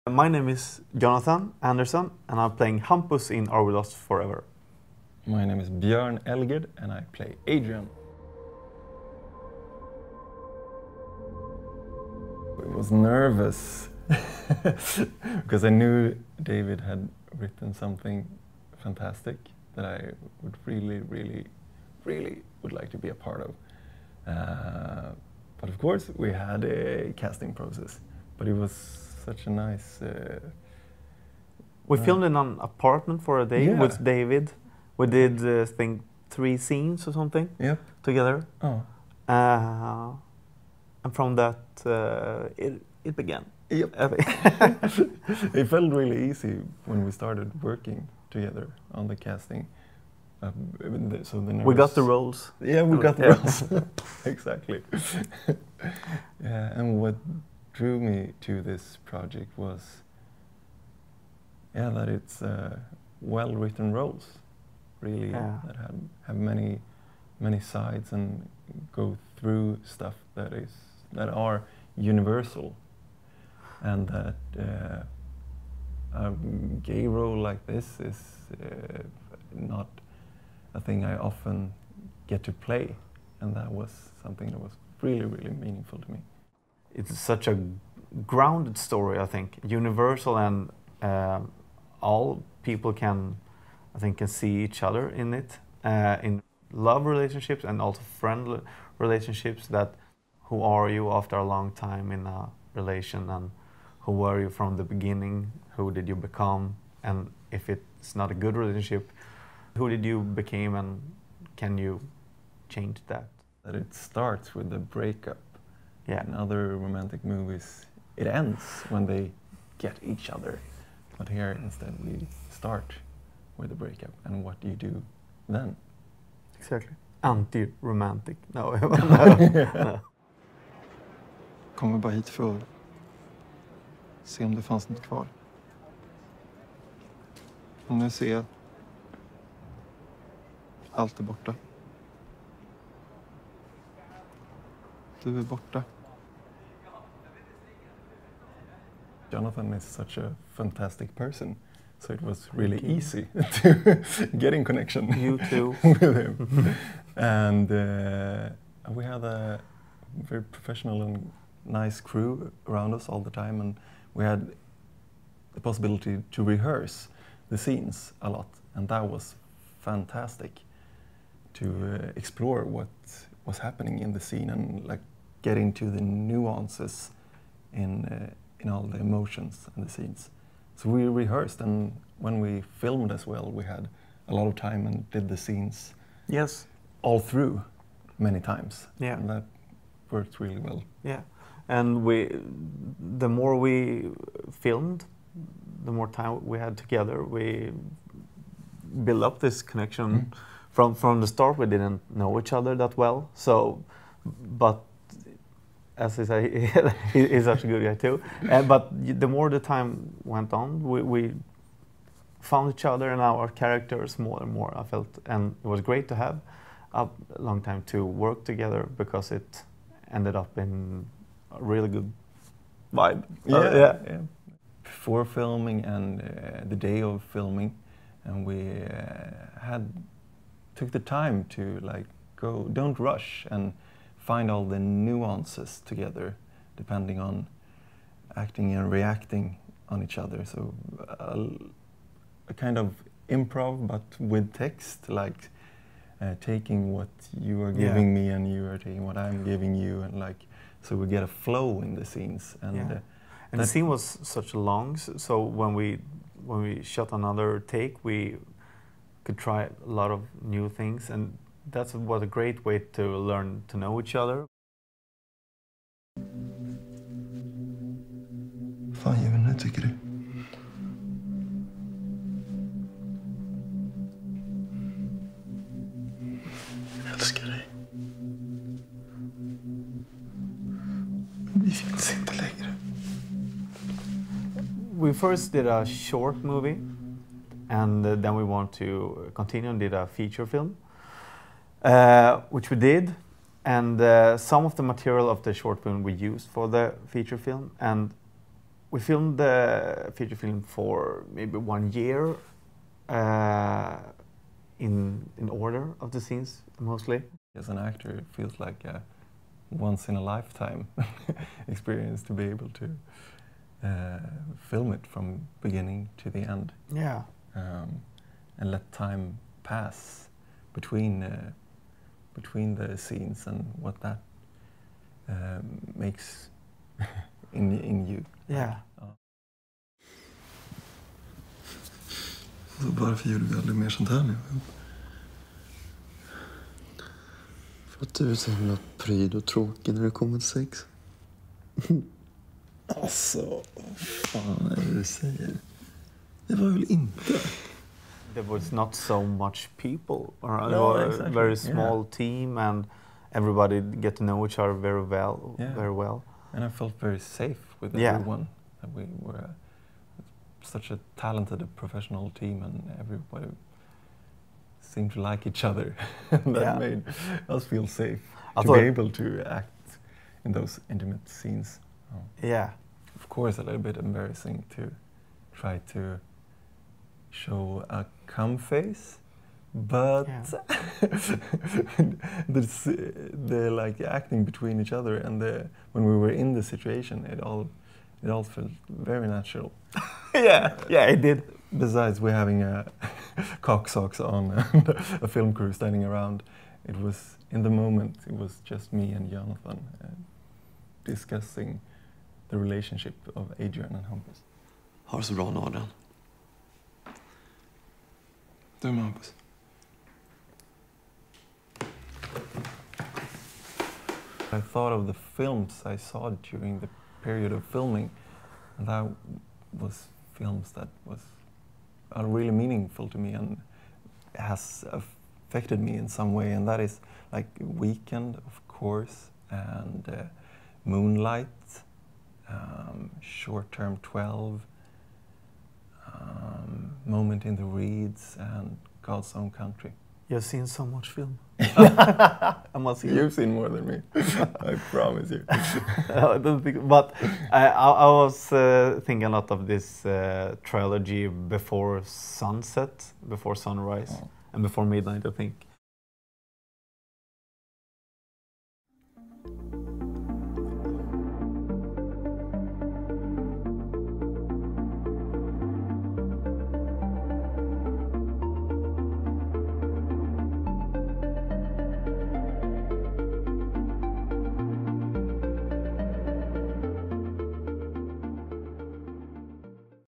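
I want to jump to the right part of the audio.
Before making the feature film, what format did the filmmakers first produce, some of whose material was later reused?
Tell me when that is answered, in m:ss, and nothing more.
4:45.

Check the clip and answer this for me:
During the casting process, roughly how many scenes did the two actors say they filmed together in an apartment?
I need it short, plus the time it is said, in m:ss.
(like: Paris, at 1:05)
3, at 0:36.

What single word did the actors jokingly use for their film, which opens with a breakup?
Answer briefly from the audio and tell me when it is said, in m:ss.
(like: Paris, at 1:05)
Anti-romantic, at 2:07.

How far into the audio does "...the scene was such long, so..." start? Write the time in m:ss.
4:13.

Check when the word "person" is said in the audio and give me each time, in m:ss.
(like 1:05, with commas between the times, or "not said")
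2:31.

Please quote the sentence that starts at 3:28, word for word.
Uh, but the more the time went on, we, we found each other and our characters more and more.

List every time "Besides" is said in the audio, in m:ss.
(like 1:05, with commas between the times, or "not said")
6:31.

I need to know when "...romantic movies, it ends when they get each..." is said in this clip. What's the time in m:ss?
1:56.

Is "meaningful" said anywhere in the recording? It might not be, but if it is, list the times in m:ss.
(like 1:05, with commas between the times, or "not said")
1:25, 7:02.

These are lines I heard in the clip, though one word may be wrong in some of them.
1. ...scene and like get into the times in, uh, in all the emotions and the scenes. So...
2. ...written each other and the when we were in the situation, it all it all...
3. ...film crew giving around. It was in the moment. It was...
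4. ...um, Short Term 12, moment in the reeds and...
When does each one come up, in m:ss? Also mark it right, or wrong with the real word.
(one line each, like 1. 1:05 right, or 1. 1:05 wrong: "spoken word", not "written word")
1. 2:54 wrong: "nuances", not "times"
2. 6:24 wrong: "between", not "written"
3. 6:35 wrong: "standing", not "giving"
4. 7:12 right.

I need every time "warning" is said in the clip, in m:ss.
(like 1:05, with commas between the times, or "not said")
not said.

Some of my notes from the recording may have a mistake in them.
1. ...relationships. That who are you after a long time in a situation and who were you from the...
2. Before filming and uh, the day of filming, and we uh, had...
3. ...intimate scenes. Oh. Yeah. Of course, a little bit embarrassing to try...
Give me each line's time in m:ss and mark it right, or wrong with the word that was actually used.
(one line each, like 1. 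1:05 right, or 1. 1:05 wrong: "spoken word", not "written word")
1. 1:38 wrong: "relation", not "situation"
2. 3:44 right
3. 6:10 right.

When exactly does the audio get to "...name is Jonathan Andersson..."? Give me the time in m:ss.
0:00.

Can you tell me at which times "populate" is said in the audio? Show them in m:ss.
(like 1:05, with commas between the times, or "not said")
not said.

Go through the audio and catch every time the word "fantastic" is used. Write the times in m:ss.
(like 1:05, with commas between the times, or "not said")
0:18, 2:30, 2:49.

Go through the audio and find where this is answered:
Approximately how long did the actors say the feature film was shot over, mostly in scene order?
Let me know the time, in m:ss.
5:01.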